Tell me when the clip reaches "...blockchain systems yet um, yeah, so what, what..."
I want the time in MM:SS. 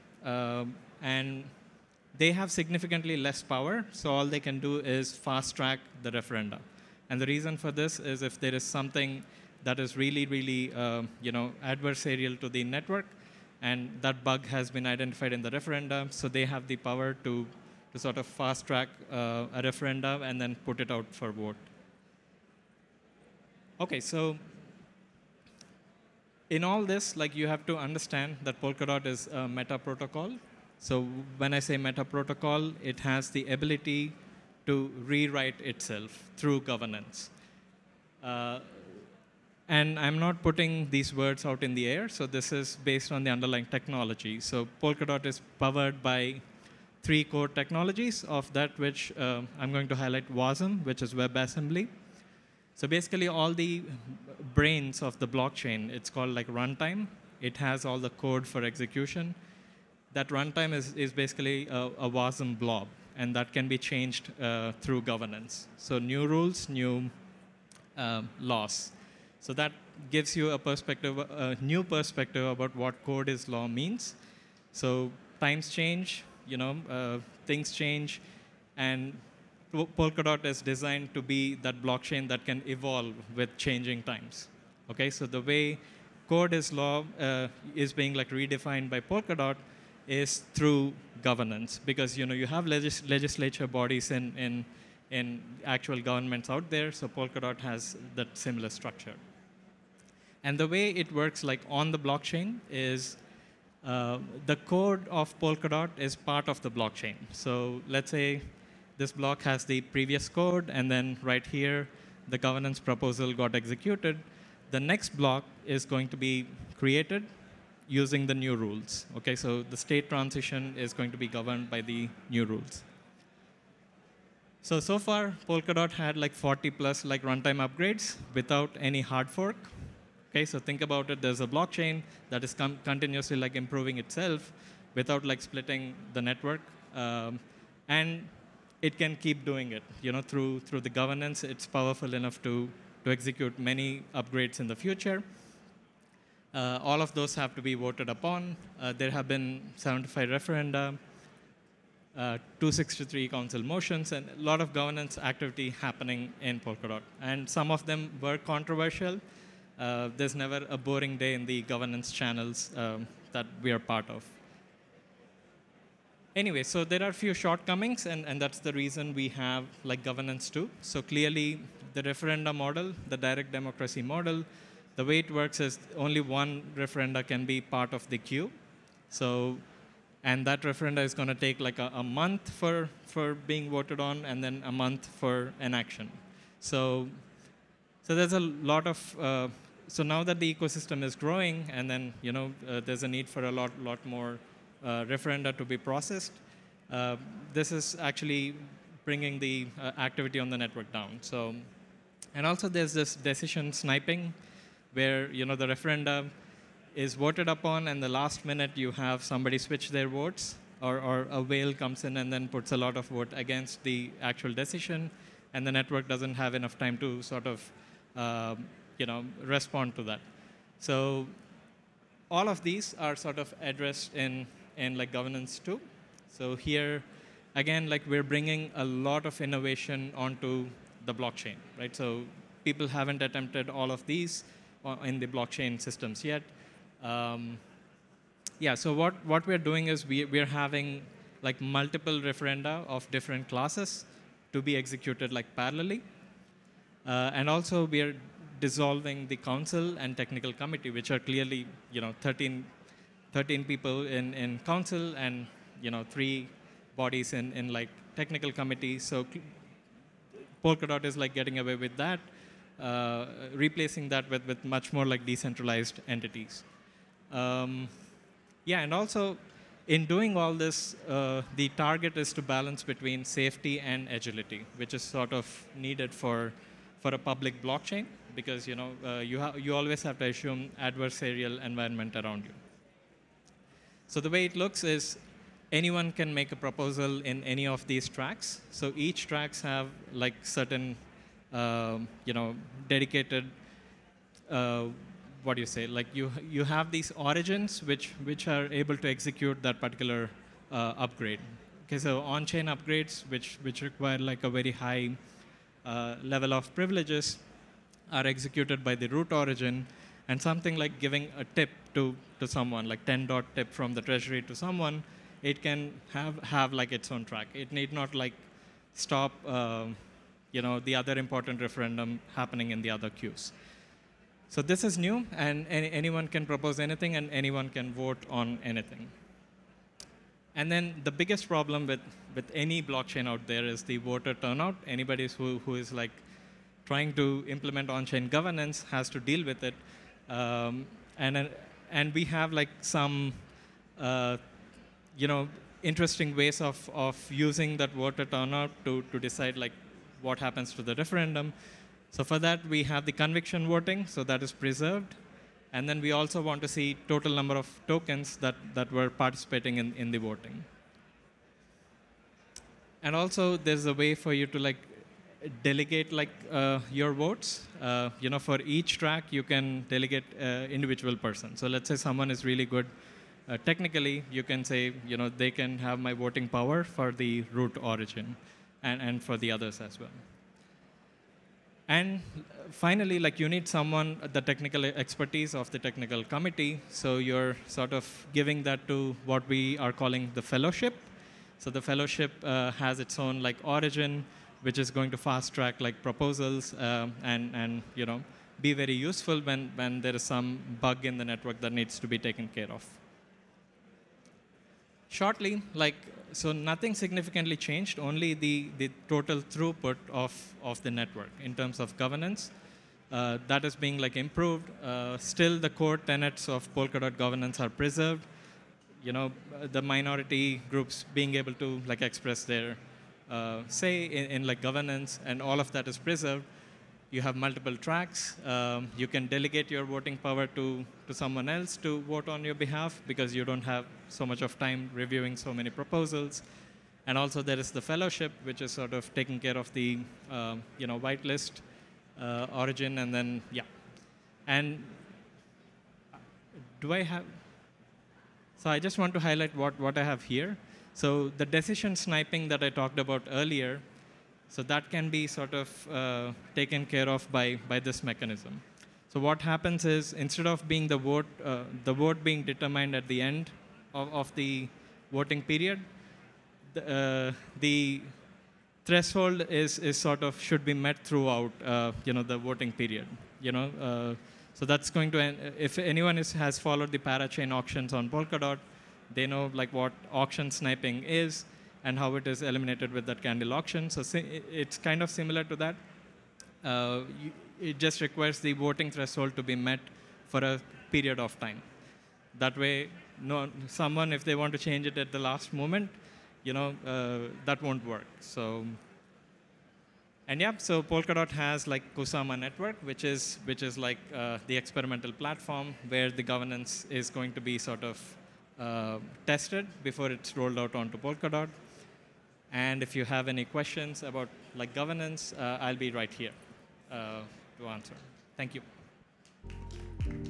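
03:55.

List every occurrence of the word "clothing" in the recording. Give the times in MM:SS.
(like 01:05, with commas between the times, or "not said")
not said.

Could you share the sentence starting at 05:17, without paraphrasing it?
It need not like stop uh, you know, the other important referendum happening in the other queues.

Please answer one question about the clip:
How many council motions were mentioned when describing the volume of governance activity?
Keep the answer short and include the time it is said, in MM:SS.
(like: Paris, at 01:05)
263, at 02:32.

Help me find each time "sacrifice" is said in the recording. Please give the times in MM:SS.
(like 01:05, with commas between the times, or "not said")
not said.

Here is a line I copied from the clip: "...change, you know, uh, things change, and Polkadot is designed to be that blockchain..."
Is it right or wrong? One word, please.
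right.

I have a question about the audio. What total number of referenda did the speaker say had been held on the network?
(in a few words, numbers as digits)
75.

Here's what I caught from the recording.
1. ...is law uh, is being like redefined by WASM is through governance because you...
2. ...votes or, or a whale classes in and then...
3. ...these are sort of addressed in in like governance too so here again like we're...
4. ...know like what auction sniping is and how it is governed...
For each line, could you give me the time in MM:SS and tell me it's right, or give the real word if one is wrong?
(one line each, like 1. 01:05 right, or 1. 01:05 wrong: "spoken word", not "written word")
1. 01:26 wrong: "Polkadot", not "WASM"
2. 03:30 wrong: "comes", not "classes"
3. 03:42 right
4. 07:59 wrong: "eliminated", not "governed".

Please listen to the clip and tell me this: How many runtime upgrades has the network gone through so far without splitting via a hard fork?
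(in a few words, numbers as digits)
40.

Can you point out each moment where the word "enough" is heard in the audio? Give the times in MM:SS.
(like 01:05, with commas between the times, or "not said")
02:22, 03:36.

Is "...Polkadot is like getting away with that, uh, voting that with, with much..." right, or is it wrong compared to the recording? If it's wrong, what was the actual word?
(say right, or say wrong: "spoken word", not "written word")
wrong: "replacing", not "voting".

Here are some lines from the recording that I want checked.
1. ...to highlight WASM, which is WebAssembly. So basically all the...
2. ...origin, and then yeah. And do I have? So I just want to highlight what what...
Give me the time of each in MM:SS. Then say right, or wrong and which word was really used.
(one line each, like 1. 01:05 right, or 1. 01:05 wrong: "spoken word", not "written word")
1. 00:49 right
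2. 07:22 right.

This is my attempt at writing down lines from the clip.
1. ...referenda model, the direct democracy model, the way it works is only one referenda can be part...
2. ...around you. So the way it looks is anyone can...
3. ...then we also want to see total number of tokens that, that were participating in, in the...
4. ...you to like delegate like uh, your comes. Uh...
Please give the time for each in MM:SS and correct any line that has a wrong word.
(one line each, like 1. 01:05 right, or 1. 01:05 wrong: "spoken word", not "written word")
1. 02:52 right
2. 04:42 right
3. 05:55 right
4. 06:04 wrong: "votes", not "comes".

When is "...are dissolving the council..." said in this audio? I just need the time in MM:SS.
04:08.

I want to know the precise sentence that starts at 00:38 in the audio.
Uh, and I'm not putting these words out in the air, so this is based on the underlying technology.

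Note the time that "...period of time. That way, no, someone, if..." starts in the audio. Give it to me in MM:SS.
08:10.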